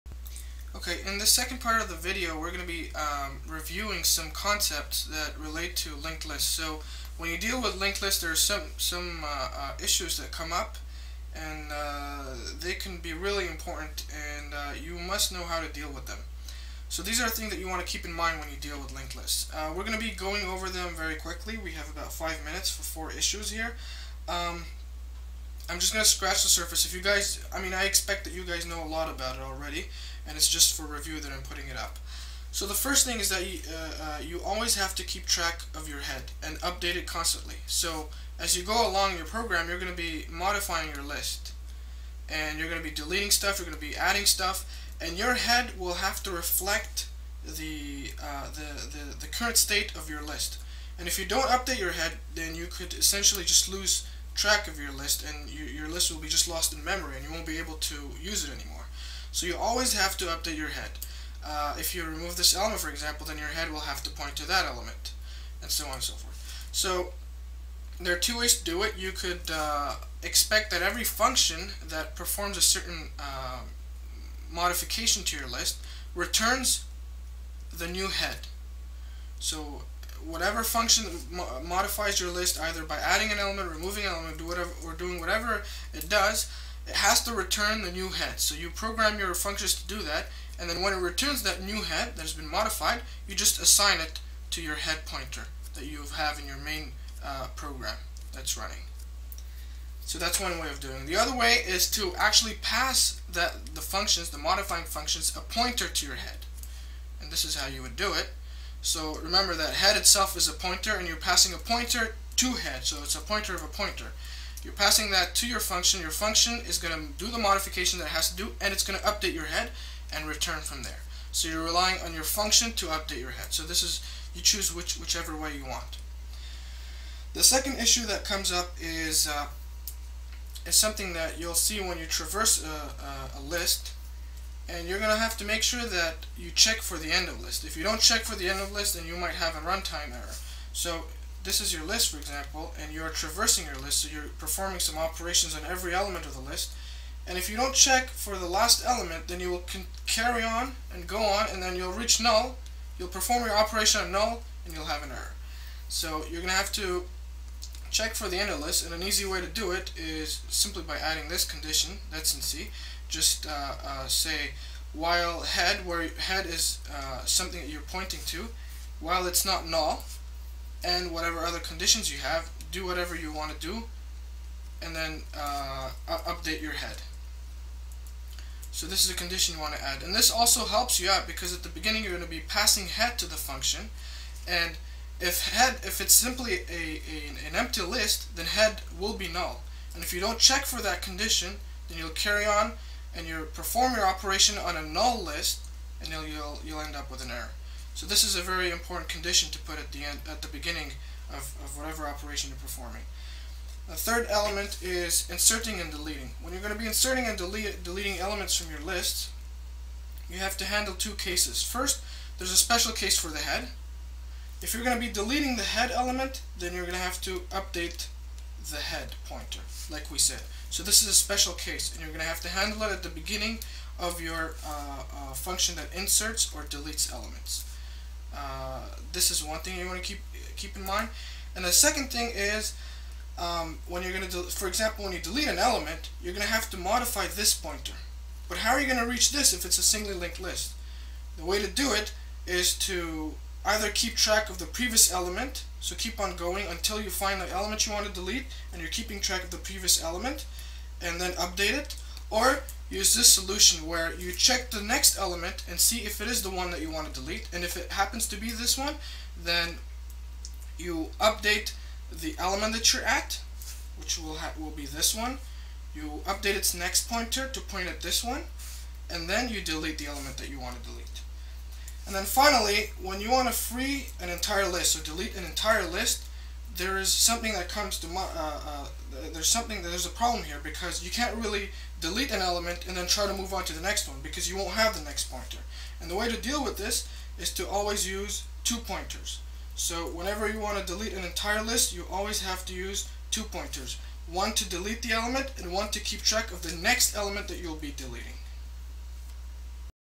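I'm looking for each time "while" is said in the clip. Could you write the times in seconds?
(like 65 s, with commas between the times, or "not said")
164 s, 169 s.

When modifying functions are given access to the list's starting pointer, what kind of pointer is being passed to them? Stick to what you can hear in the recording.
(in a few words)
a pointer of a pointer.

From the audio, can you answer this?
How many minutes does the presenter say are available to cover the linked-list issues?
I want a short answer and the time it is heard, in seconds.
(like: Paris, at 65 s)
5, at 22 s.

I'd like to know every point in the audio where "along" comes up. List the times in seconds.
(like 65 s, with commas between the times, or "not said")
38 s.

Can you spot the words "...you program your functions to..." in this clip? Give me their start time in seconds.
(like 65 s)
88 s.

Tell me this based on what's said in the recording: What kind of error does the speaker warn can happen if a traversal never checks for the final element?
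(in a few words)
runtime error.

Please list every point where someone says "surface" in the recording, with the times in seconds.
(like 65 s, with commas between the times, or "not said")
26 s.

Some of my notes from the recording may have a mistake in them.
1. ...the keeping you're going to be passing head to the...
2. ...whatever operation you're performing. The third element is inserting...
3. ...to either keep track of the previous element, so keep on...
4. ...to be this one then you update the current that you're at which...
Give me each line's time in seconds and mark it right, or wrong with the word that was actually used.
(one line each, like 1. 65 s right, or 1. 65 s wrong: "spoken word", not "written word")
1. 181 s wrong: "beginning", not "keeping"
2. 201 s right
3. 242 s right
4. 258 s wrong: "element", not "current".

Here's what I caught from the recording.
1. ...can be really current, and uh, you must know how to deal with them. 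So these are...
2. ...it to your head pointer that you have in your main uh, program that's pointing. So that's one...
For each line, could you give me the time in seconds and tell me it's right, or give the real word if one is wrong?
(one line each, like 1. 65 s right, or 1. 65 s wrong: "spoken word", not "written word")
1. 12 s wrong: "important", not "current"
2. 93 s wrong: "running", not "pointing".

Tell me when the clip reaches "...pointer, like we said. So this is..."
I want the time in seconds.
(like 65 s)
219 s.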